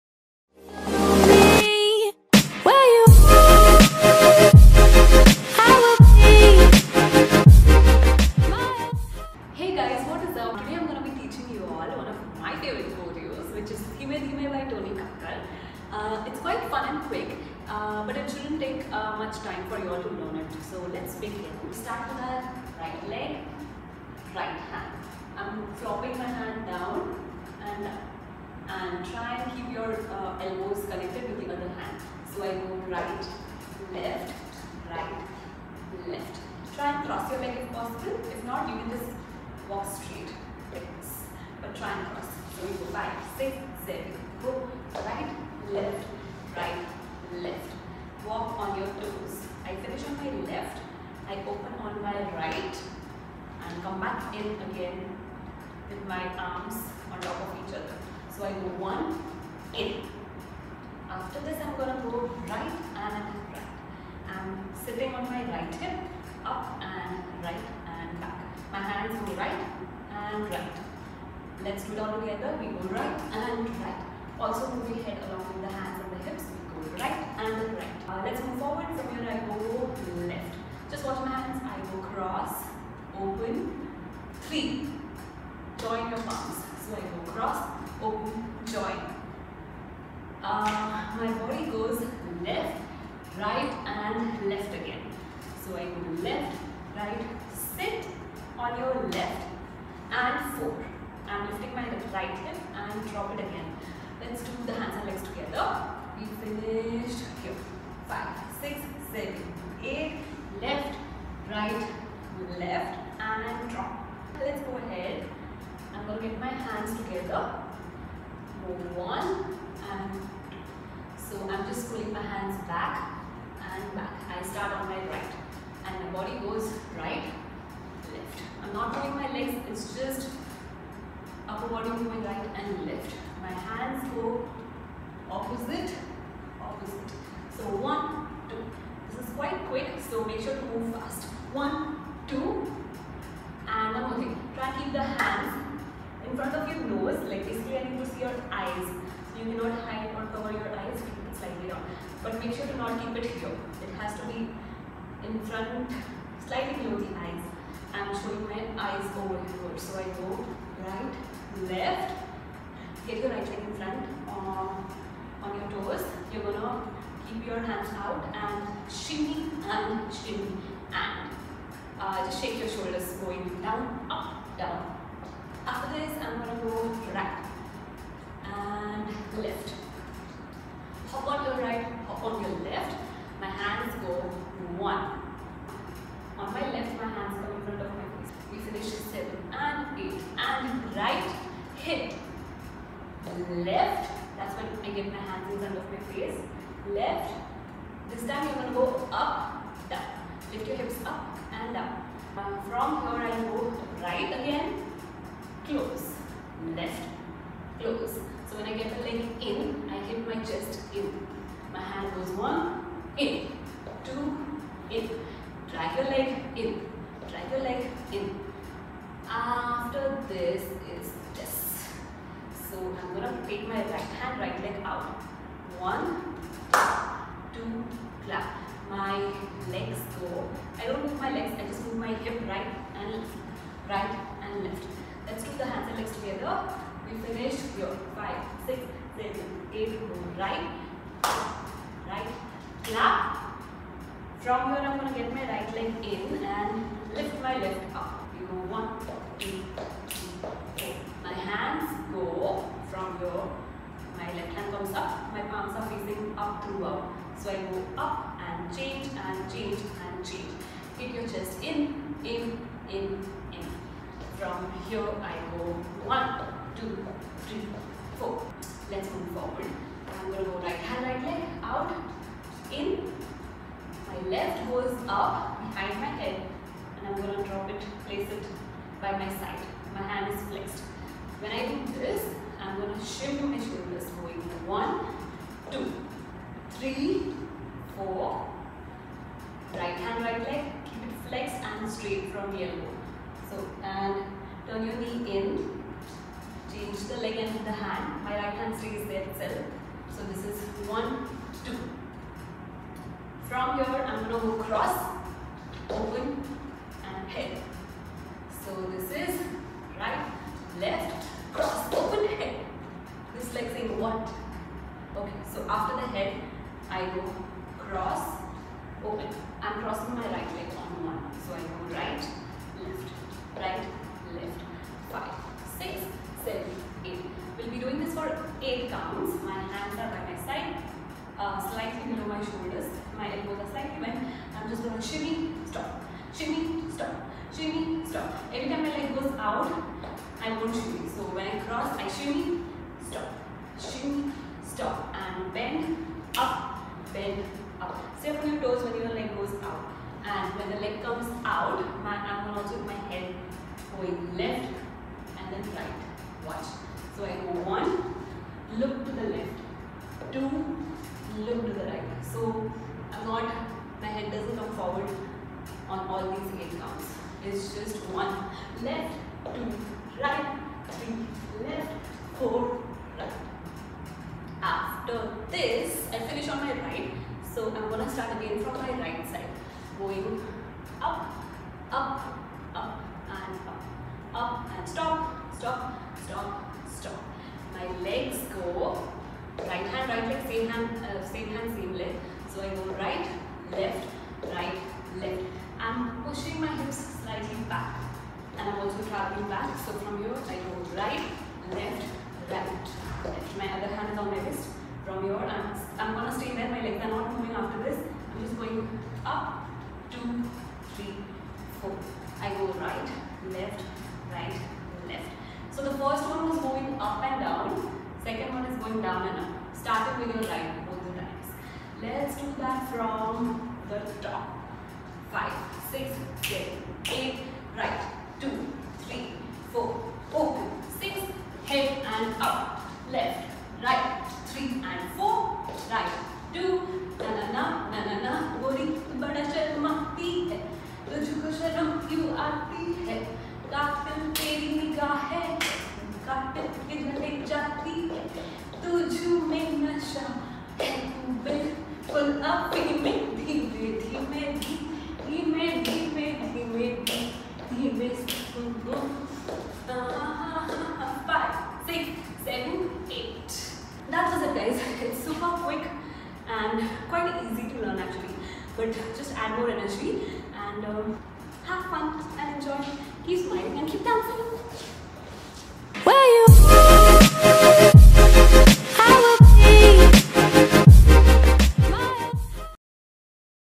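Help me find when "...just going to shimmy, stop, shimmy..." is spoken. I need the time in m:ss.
5:34.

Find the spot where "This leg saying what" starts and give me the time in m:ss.
5:13.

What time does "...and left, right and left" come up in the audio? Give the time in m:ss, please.
3:52.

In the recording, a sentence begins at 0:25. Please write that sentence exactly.
I'm flopping my hand down and, and try and keep your uh, elbows connected with the other hand.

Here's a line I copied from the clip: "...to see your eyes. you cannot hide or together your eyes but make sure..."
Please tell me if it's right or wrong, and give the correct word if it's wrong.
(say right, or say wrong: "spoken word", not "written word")
wrong: "cover", not "together".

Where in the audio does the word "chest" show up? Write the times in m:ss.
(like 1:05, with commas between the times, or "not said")
3:30, 4:21.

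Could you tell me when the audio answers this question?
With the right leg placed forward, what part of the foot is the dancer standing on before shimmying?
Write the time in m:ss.
2:45.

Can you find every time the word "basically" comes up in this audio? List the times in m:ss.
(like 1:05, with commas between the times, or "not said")
2:27.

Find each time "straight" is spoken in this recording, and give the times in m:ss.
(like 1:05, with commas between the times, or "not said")
0:39, 4:51.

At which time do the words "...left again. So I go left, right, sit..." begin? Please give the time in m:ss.
1:34.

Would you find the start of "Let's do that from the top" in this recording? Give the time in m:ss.
7:02.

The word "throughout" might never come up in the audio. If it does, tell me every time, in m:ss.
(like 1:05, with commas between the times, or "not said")
4:16.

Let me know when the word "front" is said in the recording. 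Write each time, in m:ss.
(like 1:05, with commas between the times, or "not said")
2:26, 2:35, 2:43.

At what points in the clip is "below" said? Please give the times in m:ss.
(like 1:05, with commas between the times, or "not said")
2:36, 5:32.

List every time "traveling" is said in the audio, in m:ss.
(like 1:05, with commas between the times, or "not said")
6:39.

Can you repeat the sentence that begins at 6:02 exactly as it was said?
So I'm not, my head doesn't come forward on all these eight counts.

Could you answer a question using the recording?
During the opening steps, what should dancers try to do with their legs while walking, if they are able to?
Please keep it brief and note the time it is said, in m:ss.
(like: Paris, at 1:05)
Cross your leg, at 0:37.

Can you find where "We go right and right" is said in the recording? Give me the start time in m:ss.
1:12.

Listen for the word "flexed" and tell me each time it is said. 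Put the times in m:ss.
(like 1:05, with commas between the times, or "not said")
4:40, 4:51.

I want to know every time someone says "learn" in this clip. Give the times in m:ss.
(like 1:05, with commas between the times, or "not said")
0:20.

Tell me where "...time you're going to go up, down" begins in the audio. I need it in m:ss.
3:18.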